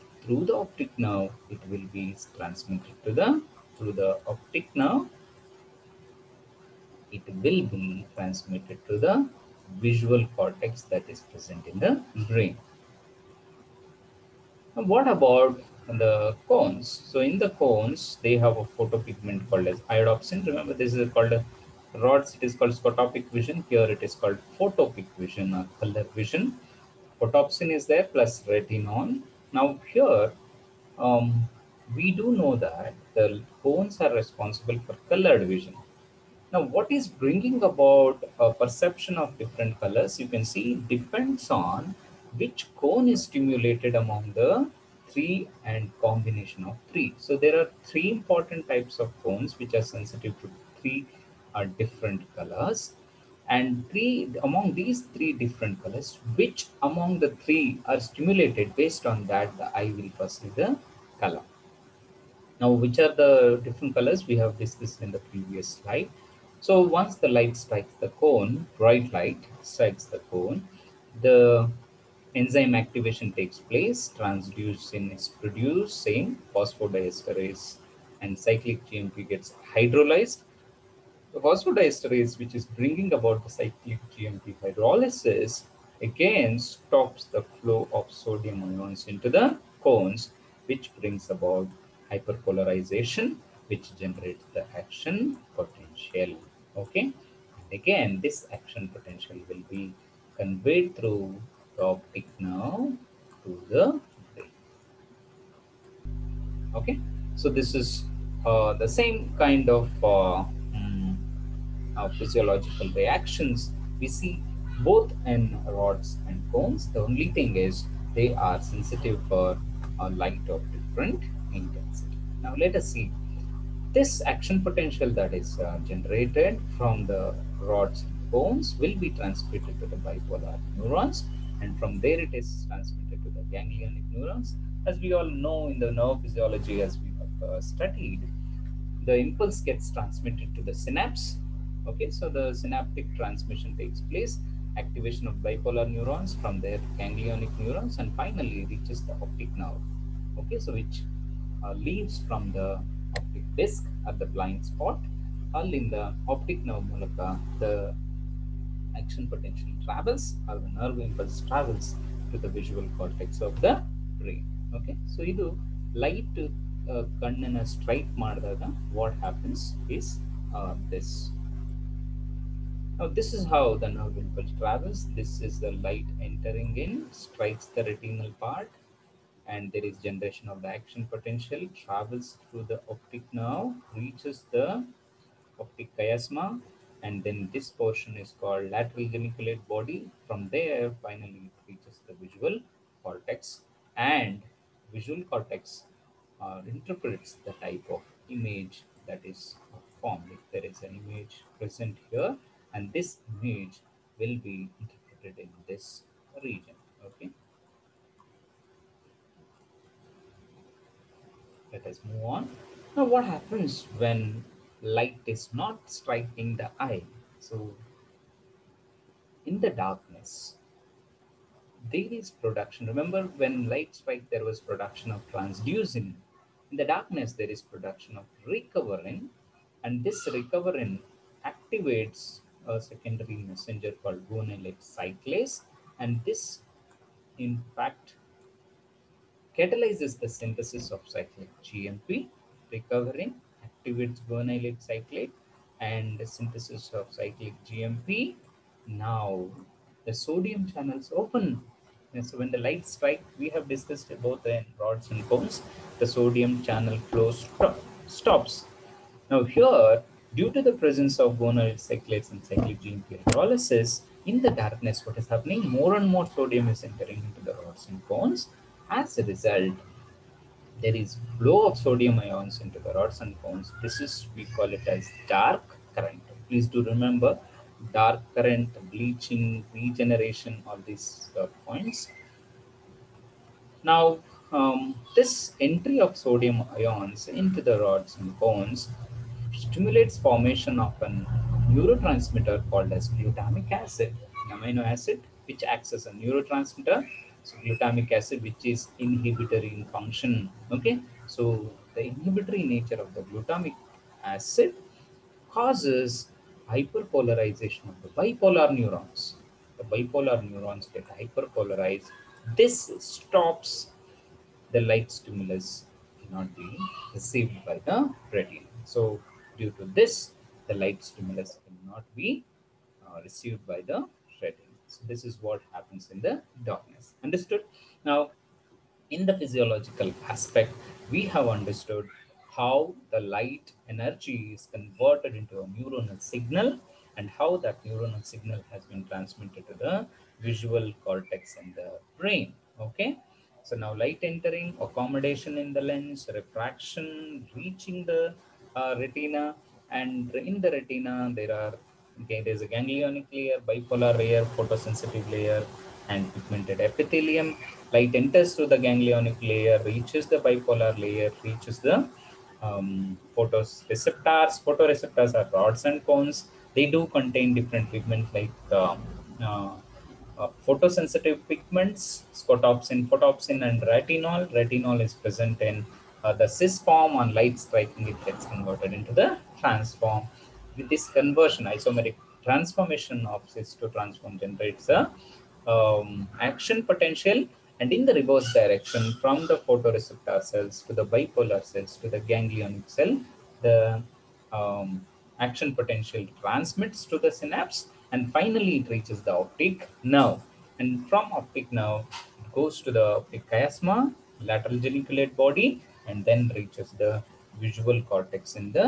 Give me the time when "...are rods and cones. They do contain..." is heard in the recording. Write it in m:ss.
6:05.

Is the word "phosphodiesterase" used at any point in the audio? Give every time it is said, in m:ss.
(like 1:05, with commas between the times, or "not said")
1:16, 1:21.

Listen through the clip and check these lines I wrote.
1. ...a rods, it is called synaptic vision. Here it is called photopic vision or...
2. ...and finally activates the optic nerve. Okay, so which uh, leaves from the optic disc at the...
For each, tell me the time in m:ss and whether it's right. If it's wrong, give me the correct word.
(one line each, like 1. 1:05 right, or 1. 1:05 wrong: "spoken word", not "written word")
1. 0:21 wrong: "scotopic", not "synaptic"
2. 2:27 wrong: "reaches", not "activates".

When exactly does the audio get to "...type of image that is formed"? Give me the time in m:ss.
3:17.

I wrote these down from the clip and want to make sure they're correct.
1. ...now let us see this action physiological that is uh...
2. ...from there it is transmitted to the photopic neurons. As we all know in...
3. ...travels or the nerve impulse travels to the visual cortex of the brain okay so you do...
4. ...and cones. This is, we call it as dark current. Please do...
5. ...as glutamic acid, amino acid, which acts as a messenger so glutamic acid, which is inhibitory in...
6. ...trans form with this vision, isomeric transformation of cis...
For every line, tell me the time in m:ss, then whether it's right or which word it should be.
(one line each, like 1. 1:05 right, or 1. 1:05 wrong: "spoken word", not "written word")
1. 2:02 wrong: "potential", not "physiological"
2. 2:11 wrong: "ganglionic", not "photopic"
3. 2:39 right
4. 4:33 right
5. 4:52 wrong: "neurotransmitter", not "messenger"
6. 6:19 wrong: "conversion", not "vision".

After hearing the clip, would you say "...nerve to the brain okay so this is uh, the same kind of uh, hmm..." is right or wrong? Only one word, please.
right.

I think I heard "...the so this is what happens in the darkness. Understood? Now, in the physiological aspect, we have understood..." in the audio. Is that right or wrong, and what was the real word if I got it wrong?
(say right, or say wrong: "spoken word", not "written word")
right.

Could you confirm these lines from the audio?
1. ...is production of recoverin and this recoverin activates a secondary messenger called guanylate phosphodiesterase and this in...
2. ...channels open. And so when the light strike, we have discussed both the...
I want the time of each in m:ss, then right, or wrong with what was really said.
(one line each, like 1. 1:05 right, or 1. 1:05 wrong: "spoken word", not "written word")
1. 3:47 wrong: "cyclase", not "phosphodiesterase"
2. 4:10 right.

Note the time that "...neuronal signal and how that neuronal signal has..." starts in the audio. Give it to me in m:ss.
5:35.